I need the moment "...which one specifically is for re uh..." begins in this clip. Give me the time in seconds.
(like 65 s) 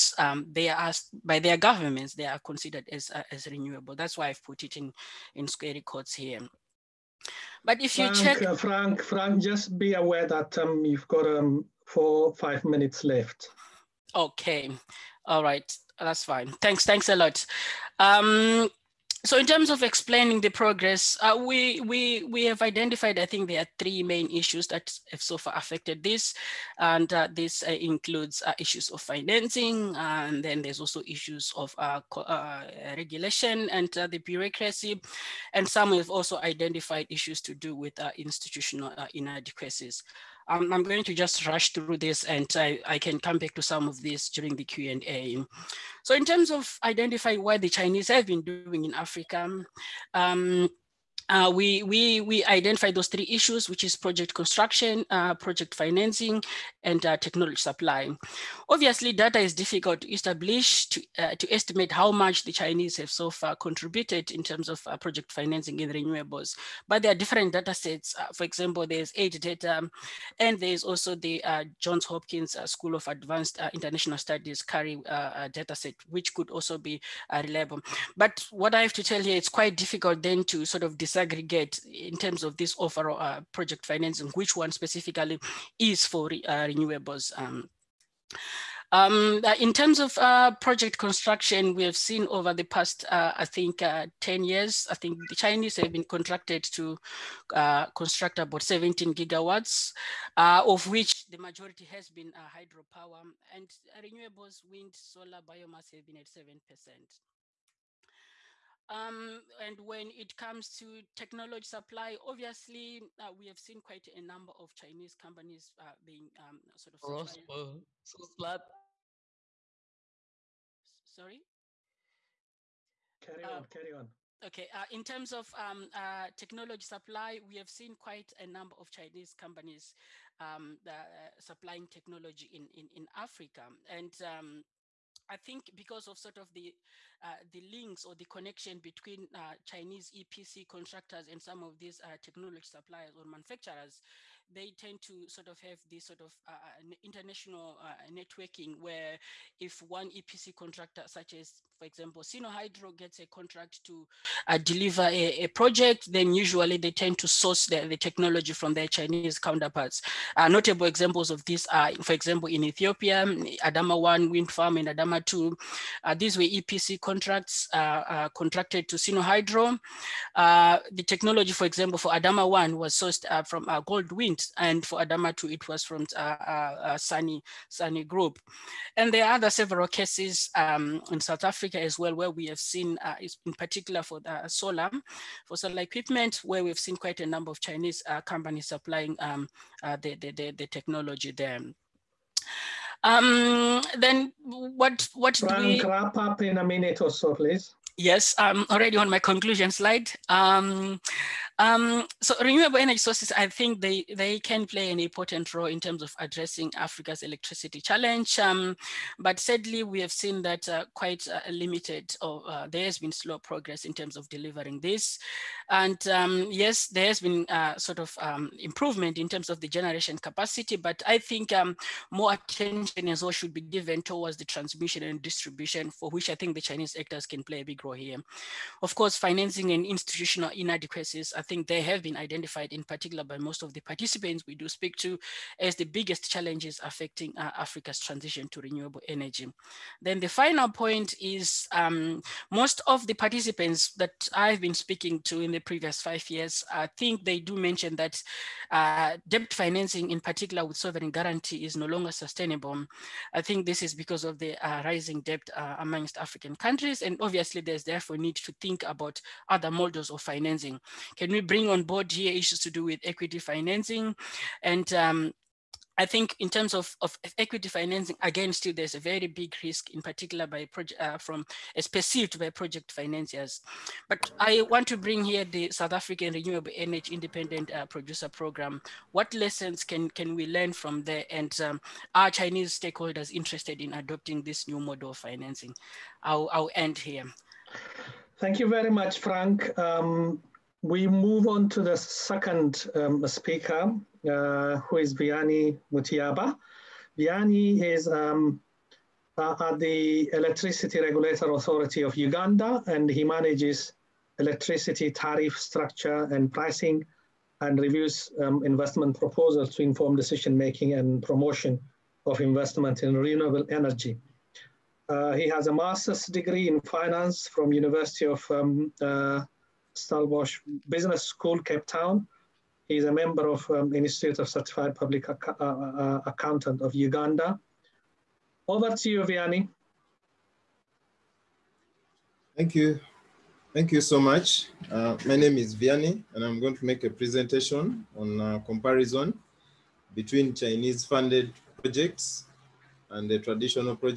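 84 s.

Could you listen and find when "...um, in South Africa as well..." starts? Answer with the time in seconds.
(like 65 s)
180 s.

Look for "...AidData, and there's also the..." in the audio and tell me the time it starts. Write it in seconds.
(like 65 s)
69 s.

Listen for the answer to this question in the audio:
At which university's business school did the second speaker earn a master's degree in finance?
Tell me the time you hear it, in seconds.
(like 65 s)
319 s.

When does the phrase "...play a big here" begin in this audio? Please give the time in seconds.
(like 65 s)
227 s.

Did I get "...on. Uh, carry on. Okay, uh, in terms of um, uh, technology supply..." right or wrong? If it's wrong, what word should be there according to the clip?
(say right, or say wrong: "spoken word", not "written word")
right.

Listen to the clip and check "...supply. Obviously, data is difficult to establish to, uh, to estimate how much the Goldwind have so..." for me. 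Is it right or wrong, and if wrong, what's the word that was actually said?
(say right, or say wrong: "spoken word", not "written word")
wrong: "Chinese", not "Goldwind".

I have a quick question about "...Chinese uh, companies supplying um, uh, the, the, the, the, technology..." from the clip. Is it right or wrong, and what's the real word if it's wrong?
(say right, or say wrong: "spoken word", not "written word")
right.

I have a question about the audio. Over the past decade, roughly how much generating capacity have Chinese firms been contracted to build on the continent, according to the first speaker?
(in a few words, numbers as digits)
17 gigawatts.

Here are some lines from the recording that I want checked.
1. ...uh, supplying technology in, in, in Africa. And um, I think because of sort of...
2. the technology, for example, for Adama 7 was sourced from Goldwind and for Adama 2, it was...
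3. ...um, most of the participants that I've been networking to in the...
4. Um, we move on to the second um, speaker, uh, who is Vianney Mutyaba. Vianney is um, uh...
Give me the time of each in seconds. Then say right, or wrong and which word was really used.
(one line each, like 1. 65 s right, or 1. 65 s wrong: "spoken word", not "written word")
1. 130 s right
2. 170 s wrong: "1", not "7"
3. 241 s wrong: "speaking", not "networking"
4. 289 s right.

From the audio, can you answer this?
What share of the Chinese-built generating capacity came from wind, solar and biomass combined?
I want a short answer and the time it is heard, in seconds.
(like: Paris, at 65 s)
7%, at 106 s.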